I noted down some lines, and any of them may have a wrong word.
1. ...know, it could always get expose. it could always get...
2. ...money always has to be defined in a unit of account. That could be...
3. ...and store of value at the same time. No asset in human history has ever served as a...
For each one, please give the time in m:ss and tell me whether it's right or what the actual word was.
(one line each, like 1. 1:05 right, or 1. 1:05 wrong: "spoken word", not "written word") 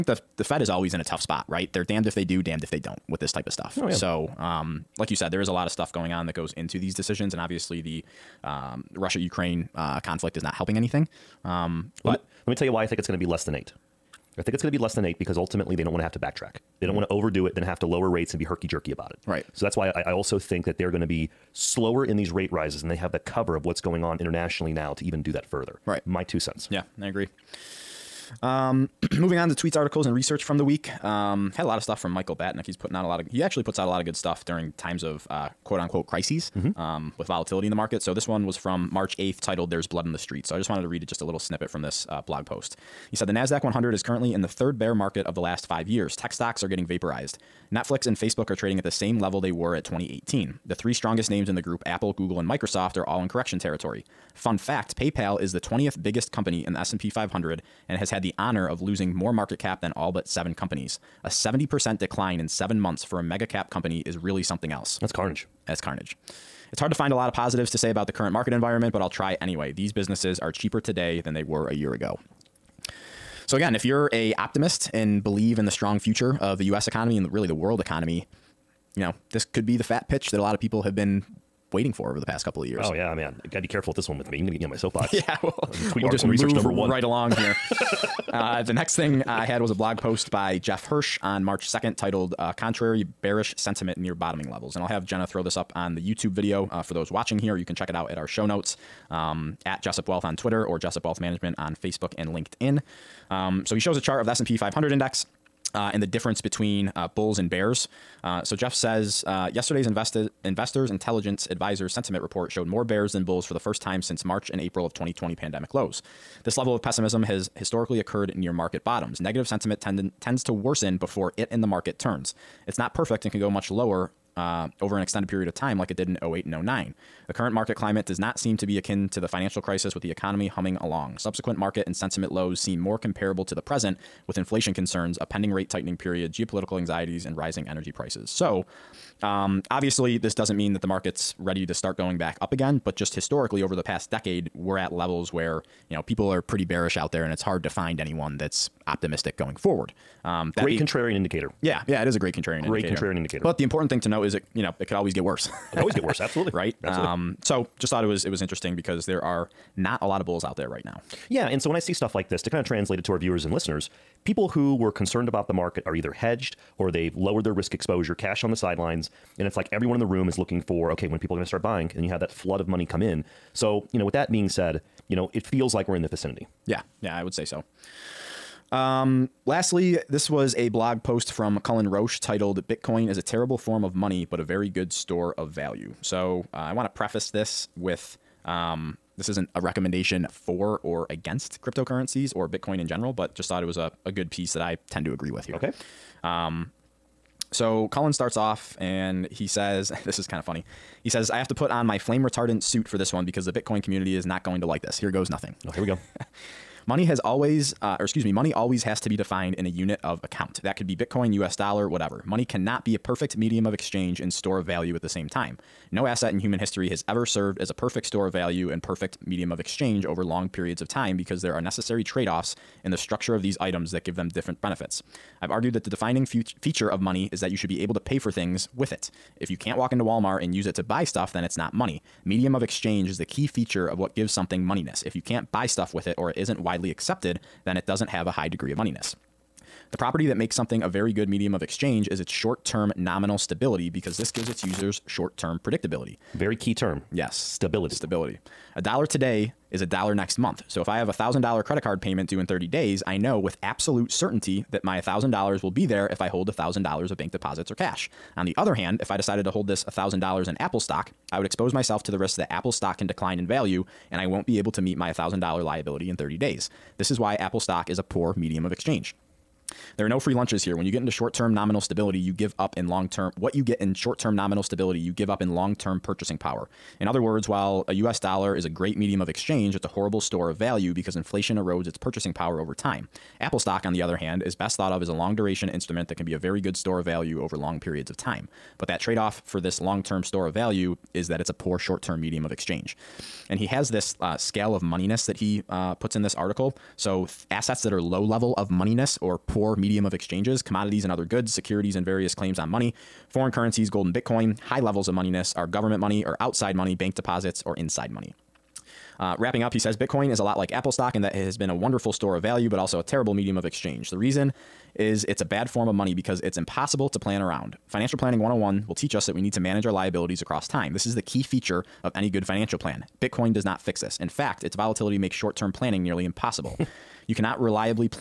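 1. 2:34 wrong: "worse", not "expose"
2. 3:28 right
3. 3:34 right.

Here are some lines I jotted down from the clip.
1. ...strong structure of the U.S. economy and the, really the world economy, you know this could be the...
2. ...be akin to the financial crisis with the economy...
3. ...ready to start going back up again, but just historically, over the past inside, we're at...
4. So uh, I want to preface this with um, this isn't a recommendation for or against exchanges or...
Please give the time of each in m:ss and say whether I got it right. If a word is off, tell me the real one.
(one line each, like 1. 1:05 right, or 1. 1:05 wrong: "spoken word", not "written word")
1. 1:15 wrong: "future", not "structure"
2. 2:08 right
3. 2:21 wrong: "decade", not "inside"
4. 3:06 wrong: "cryptocurrencies", not "exchanges".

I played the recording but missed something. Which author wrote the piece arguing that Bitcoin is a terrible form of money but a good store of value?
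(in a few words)
Cullen Roche.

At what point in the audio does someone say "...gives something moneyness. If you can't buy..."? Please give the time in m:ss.
3:54.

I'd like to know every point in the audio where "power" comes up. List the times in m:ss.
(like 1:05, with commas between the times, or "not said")
4:36, 4:42.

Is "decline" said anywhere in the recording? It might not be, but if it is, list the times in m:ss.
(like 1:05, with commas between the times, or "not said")
1:02, 4:23.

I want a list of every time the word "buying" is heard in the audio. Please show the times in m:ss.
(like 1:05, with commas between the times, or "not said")
2:51.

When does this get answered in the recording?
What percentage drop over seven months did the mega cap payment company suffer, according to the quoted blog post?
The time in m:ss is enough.
1:01.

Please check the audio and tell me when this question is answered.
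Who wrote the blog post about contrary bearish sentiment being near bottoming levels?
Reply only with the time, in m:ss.
1:30.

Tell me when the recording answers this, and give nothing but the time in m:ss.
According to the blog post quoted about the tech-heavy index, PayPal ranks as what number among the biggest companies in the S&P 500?
0:55.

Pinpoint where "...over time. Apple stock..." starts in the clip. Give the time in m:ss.
4:42.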